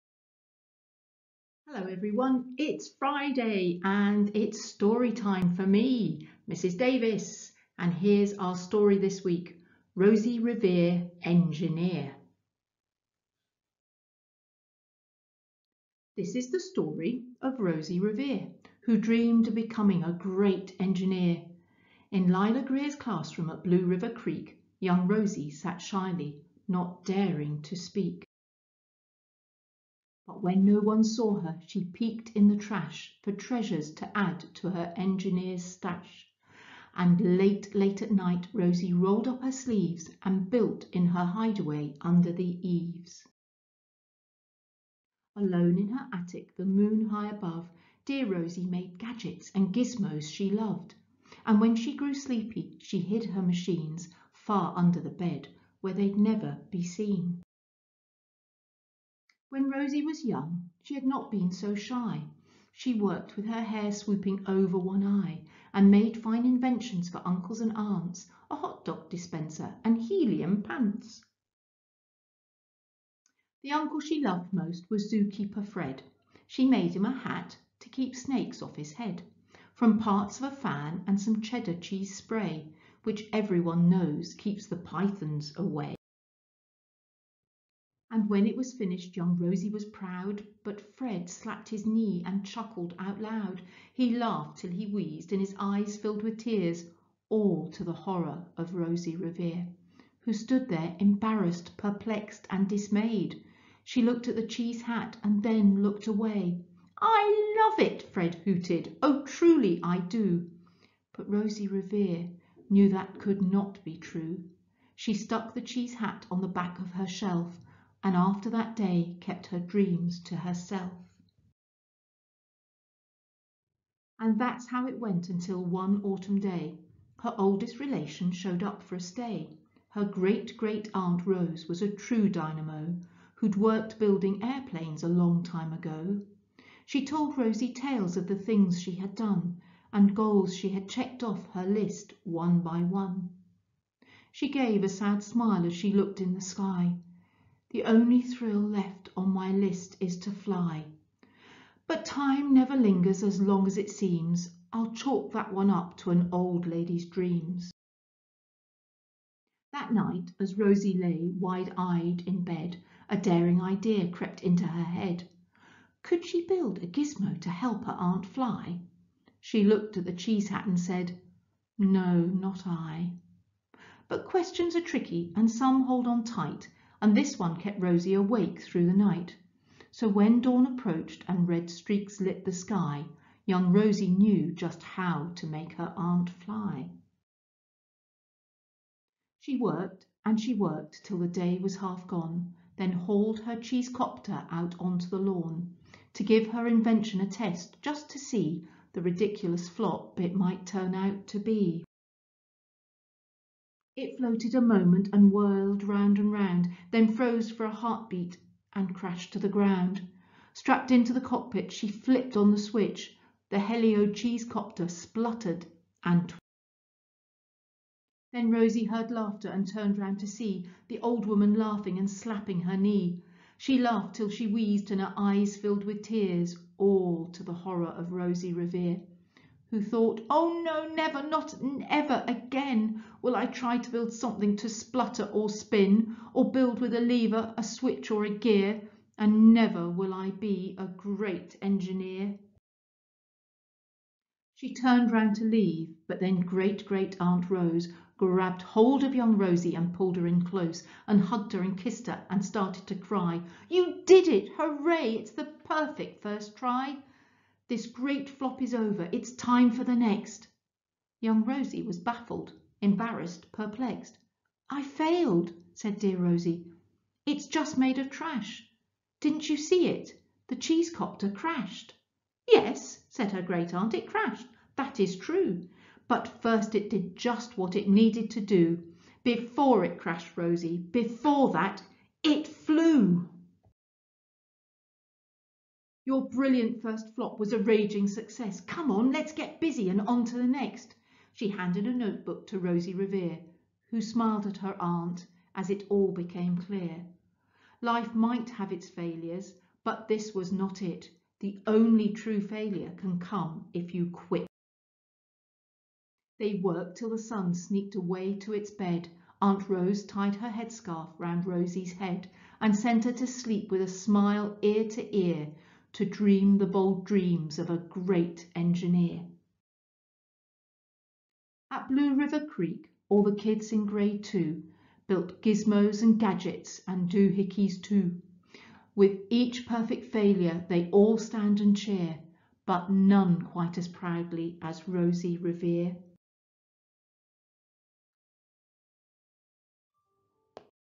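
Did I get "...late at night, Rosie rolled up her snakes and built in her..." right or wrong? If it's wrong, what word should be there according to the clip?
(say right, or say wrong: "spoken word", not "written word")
wrong: "sleeves", not "snakes".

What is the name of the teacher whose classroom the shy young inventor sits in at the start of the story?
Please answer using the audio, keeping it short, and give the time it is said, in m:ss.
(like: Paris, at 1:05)
Lila Greer, at 0:22.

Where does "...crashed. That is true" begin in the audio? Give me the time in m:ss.
4:34.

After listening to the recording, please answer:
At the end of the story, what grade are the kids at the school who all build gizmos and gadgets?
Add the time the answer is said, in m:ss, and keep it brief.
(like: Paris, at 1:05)
grade 2, at 5:23.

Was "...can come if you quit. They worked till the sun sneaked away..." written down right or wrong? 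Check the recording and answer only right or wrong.
right.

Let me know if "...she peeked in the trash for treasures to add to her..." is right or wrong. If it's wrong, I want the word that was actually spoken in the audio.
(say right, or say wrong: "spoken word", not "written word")
right.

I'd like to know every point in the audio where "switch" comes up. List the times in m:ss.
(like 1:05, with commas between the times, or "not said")
3:32, 3:57.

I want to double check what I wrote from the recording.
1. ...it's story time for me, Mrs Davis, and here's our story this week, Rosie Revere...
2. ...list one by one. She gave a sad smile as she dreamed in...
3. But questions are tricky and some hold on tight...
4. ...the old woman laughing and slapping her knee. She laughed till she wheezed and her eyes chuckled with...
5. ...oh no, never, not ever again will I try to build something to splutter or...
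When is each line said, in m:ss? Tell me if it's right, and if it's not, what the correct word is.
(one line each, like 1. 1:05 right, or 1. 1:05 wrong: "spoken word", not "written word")
1. 0:04 right
2. 2:21 wrong: "looked", not "dreamed"
3. 2:54 right
4. 3:40 wrong: "filled", not "chuckled"
5. 3:50 right.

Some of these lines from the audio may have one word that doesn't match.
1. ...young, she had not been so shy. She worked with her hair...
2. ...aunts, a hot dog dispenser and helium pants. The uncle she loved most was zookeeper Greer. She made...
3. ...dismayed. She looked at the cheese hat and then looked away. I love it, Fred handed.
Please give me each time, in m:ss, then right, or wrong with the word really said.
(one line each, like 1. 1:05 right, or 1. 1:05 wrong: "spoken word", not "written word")
1. 1:00 right
2. 1:07 wrong: "Fred", not "Greer"
3. 1:42 wrong: "hooted", not "handed".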